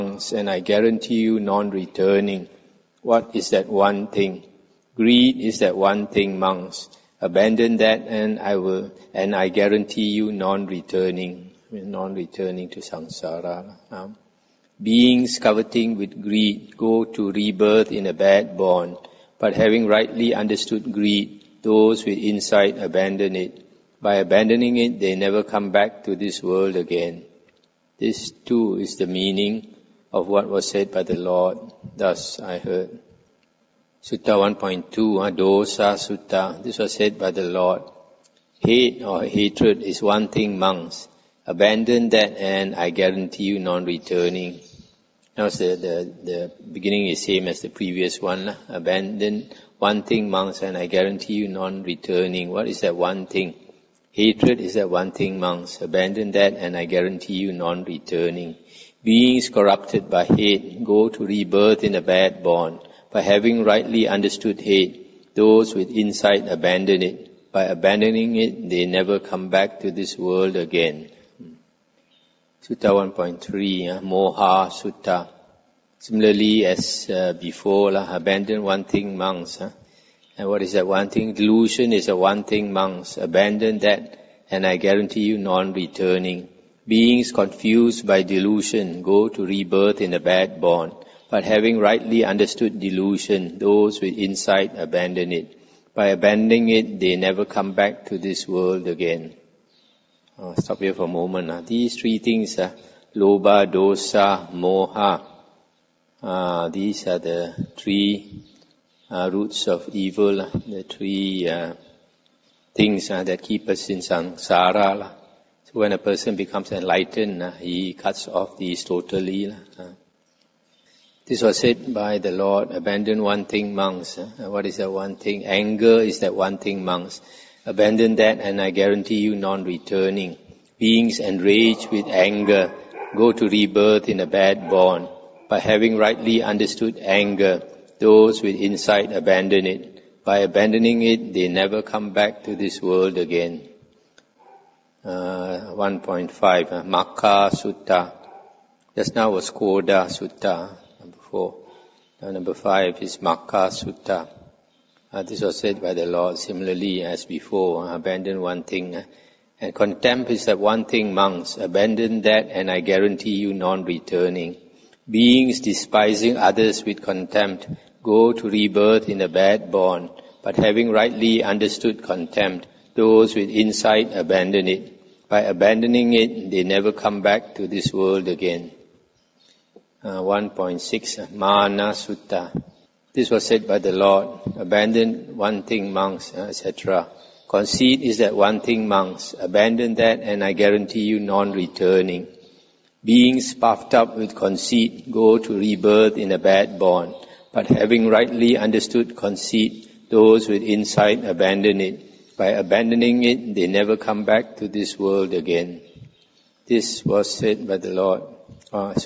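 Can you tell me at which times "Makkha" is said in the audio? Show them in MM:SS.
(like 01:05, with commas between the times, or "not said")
02:26, 02:33.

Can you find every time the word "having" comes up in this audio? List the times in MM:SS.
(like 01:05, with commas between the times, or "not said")
00:19, 01:03, 01:31, 02:15, 02:50, 03:17.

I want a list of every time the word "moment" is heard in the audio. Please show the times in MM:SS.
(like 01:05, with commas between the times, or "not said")
01:41.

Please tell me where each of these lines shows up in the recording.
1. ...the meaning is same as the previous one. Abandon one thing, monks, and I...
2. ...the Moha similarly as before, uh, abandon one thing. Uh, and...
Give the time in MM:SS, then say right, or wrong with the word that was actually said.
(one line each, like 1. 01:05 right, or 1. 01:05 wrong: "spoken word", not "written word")
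1. 00:46 wrong: "beginning", not "meaning"
2. 02:35 wrong: "Lord", not "Moha".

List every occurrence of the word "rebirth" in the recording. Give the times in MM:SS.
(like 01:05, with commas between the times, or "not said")
00:17, 01:01, 01:29, 02:13, 02:48, 03:15.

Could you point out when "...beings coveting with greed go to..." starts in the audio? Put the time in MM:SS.
00:14.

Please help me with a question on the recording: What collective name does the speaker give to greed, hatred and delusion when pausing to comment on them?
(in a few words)
roots of evil.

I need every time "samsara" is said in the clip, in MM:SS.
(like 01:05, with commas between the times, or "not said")
00:12, 01:53.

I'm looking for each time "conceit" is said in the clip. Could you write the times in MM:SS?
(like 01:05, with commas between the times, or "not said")
03:07, 03:14, 03:19.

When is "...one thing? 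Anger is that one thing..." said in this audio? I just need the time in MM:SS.
02:04.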